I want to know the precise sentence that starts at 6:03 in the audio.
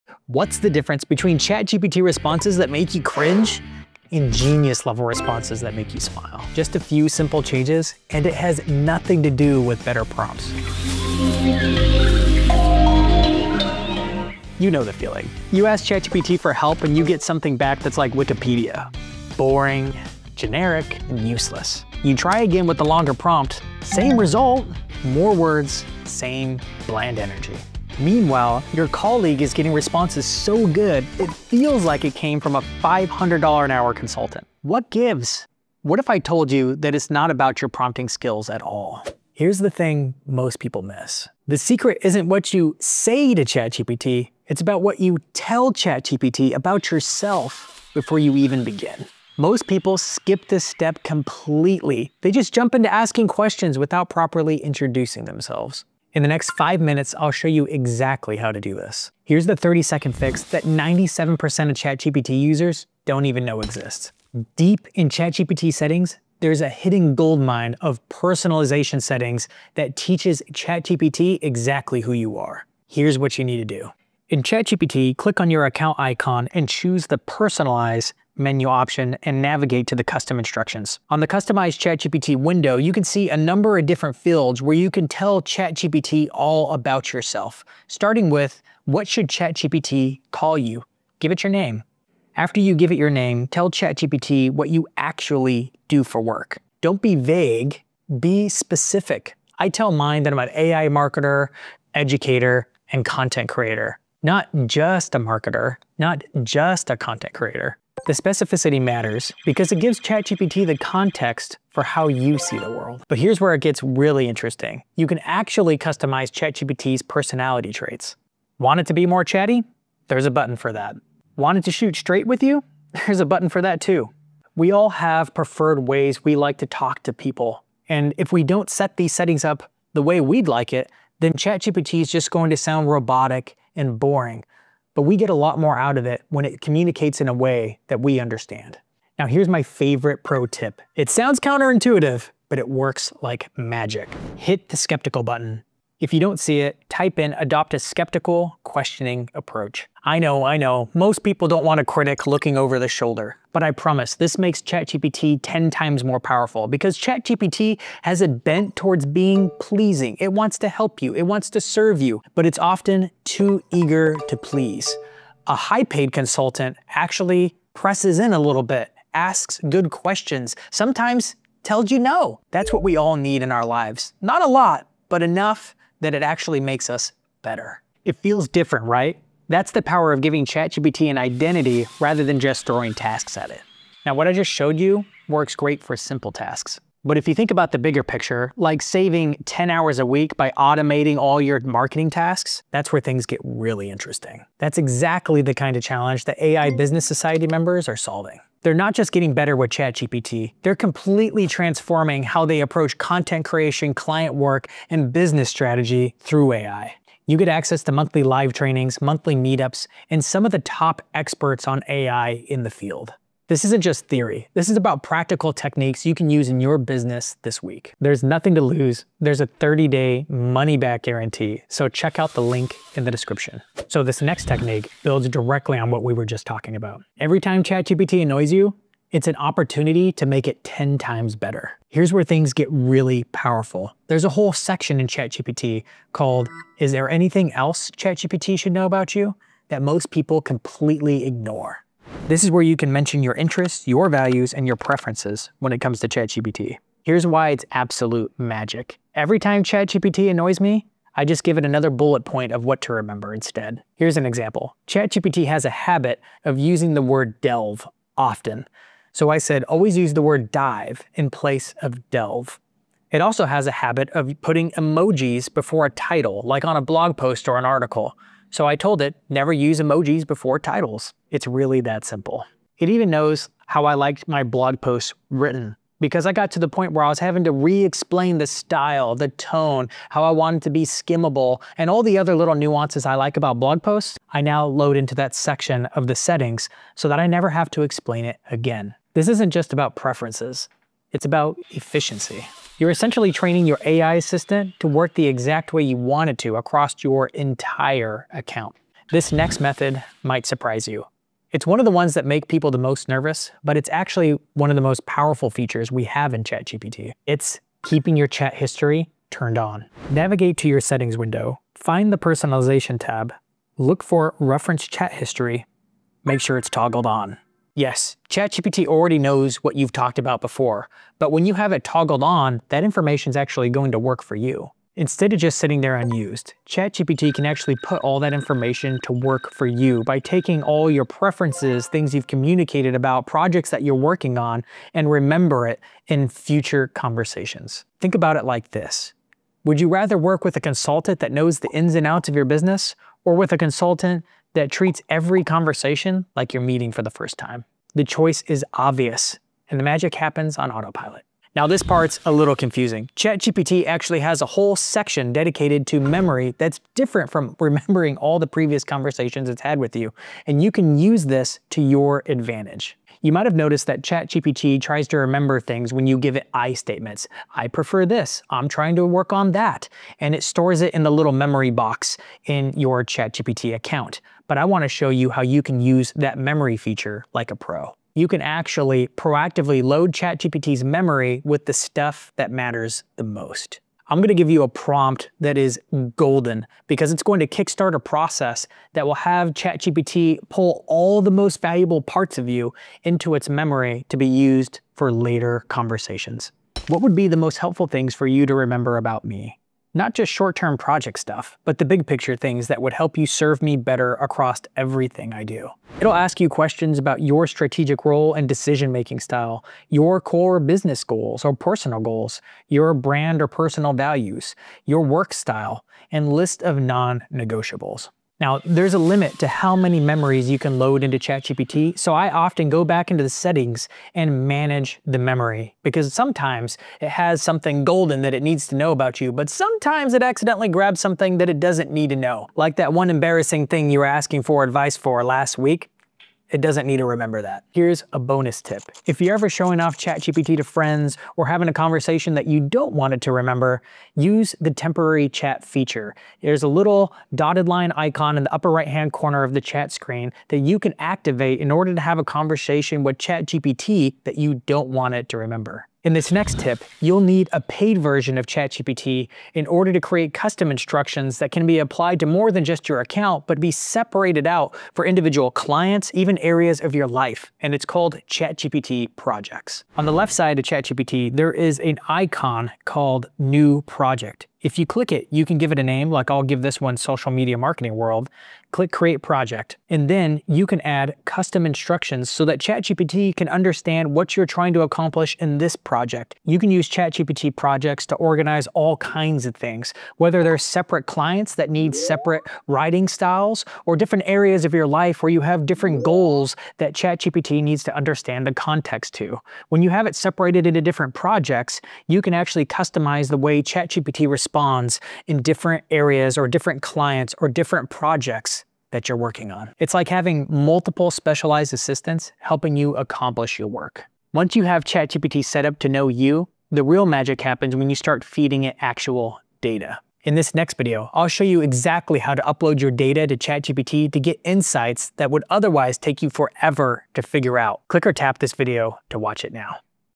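You might have noticed that ChatGPT tries to remember things when you give it I statements.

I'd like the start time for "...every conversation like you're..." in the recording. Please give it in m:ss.
5:45.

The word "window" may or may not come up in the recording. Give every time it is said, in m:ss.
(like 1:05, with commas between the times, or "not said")
1:22, 5:11.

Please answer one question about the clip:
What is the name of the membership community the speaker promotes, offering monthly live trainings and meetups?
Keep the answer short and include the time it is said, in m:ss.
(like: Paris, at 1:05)
AI Business Society, at 3:16.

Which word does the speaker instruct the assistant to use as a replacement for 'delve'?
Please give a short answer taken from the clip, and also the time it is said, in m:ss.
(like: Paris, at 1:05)
dive, at 4:20.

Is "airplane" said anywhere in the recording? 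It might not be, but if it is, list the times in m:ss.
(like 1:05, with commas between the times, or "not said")
not said.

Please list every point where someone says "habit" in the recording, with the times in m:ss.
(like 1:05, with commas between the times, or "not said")
4:15, 4:23.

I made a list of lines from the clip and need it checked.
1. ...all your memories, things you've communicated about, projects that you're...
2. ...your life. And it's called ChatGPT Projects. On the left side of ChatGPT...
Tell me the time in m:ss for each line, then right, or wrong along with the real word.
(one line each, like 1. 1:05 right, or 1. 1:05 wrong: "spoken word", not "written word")
1. 5:30 wrong: "preferences", not "memories"
2. 7:46 right.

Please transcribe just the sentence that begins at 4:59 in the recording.
This next method might surprise you.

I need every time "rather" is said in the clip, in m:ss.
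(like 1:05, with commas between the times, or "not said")
3:01, 5:39.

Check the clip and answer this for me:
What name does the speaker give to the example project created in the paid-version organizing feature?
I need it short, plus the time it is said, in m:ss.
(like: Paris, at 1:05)
Social Media Marketing World, at 7:56.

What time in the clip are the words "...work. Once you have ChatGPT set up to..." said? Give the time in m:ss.
8:33.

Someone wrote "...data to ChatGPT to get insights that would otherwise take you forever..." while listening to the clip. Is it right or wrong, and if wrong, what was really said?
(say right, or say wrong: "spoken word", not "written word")
right.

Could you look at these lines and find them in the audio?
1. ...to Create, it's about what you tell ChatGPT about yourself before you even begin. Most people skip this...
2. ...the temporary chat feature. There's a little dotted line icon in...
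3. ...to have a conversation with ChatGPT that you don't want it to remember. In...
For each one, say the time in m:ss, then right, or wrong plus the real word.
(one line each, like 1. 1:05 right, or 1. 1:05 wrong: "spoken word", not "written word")
1. 0:43 wrong: "ChatGPT", not "Create"
2. 7:24 right
3. 7:31 right.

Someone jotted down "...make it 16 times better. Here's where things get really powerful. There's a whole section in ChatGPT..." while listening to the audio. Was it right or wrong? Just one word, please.
wrong.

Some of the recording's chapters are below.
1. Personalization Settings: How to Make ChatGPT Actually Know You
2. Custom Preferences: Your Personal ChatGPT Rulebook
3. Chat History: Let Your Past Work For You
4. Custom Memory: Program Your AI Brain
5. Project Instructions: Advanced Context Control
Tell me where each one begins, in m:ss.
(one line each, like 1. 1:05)
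1. 0:59
2. 1:54
3. 3:43
4. 4:58
5. 6:03.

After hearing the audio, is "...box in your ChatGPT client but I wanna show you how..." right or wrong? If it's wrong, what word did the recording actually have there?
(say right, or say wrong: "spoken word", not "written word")
wrong: "account", not "client".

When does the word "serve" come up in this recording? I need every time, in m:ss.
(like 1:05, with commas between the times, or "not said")
2:41, 6:43.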